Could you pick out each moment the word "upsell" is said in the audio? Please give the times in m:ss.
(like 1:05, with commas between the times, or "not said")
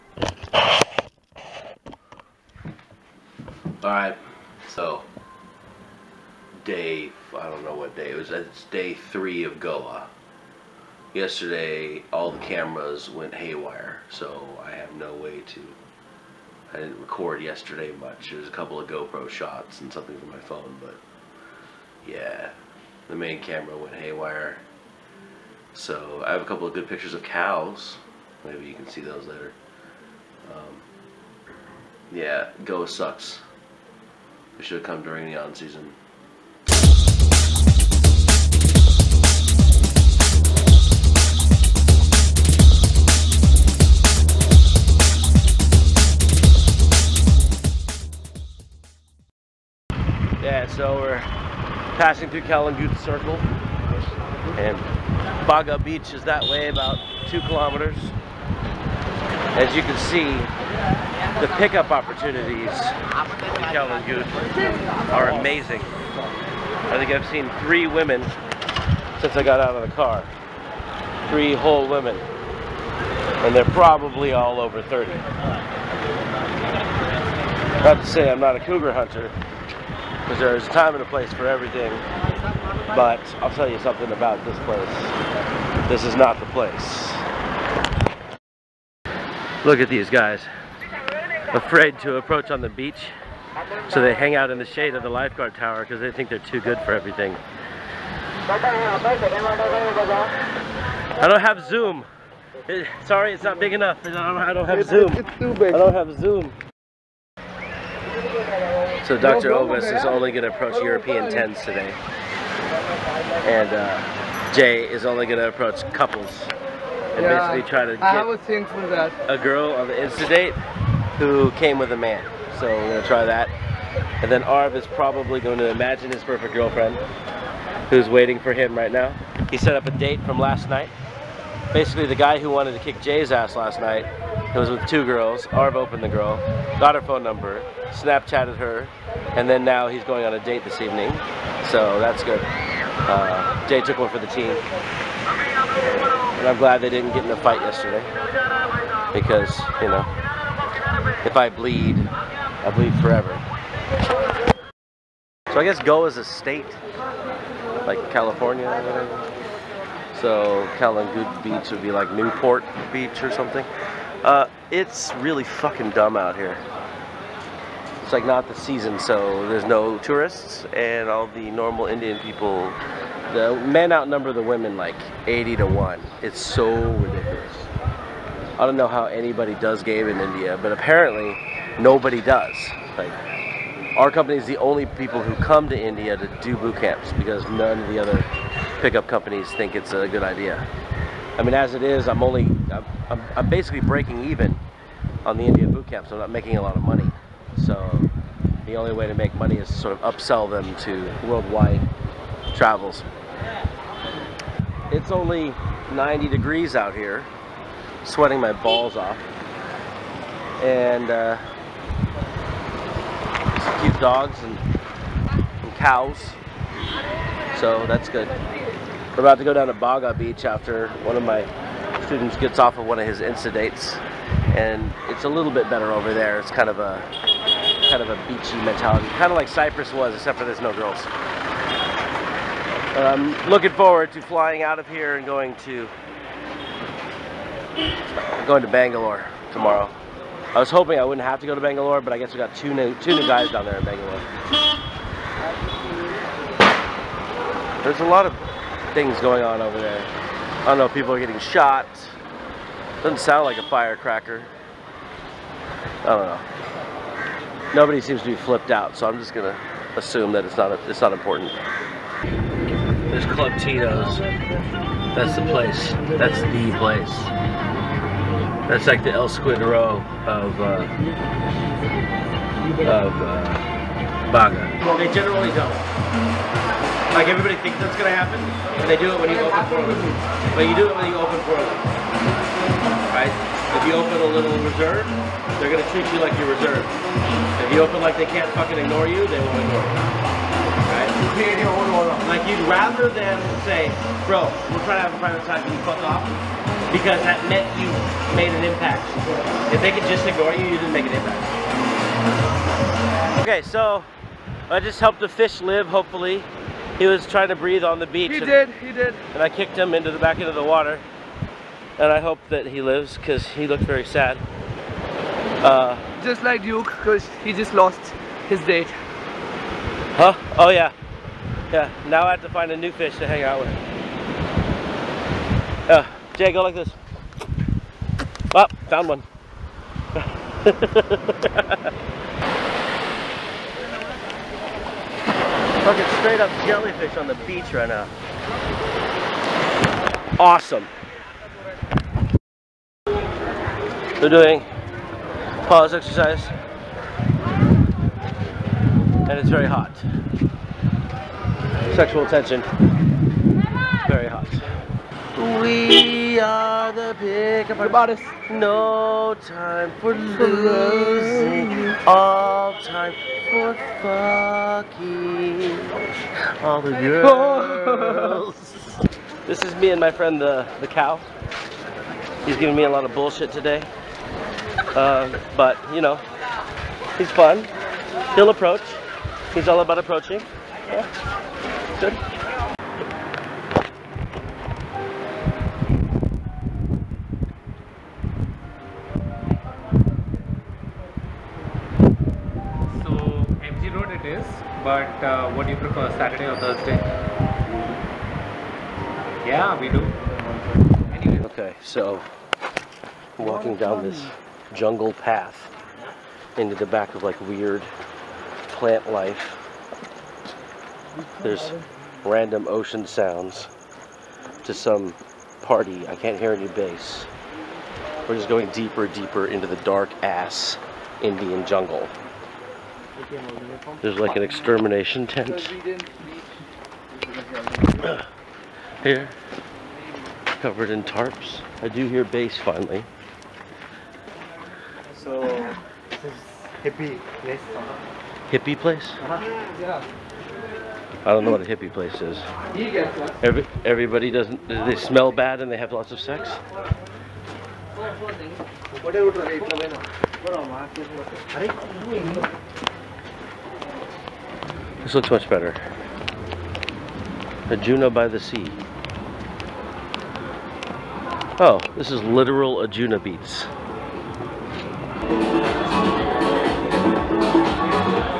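3:20.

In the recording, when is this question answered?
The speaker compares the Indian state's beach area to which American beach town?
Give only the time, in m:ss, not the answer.
2:42.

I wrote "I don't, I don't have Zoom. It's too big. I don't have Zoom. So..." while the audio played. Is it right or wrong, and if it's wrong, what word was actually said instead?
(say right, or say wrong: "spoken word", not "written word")
right.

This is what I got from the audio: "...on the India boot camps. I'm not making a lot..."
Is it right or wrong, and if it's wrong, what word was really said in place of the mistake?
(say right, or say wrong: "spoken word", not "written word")
right.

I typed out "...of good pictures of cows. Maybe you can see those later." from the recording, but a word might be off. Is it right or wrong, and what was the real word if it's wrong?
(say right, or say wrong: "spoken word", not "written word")
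right.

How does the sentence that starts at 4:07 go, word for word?
There's a lot of things going on over there.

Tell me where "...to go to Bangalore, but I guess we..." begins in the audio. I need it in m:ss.
4:01.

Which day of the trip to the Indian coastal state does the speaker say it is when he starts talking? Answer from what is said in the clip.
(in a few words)
Day 3.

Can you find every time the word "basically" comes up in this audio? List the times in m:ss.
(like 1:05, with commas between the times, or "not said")
1:57, 2:11, 3:13.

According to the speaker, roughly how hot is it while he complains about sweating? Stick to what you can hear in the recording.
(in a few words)
90 degrees.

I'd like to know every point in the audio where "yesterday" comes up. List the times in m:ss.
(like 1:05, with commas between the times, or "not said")
0:11, 0:17, 2:27.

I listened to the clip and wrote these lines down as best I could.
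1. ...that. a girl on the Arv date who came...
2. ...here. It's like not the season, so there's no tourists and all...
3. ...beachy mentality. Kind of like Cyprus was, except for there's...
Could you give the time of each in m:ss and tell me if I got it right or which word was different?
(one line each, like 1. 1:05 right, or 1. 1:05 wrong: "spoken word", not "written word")
1. 1:58 wrong: "Insta", not "Arv"
2. 2:46 right
3. 3:48 right.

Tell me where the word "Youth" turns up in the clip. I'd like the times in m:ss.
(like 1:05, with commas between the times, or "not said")
1:04.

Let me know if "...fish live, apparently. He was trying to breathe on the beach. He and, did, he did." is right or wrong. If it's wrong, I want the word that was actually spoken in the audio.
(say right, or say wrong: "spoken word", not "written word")
wrong: "hopefully", not "apparently".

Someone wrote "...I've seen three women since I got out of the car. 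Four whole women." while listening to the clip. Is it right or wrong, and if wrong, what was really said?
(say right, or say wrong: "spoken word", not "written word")
wrong: "Three", not "Four".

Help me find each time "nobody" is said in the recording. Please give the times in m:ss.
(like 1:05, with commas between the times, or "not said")
3:01, 4:17.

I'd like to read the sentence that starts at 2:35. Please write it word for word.
So I guess Goa is a state, like California or whatever.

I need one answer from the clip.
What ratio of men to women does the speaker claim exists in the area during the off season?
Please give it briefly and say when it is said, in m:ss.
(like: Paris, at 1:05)
80 to 1, at 2:55.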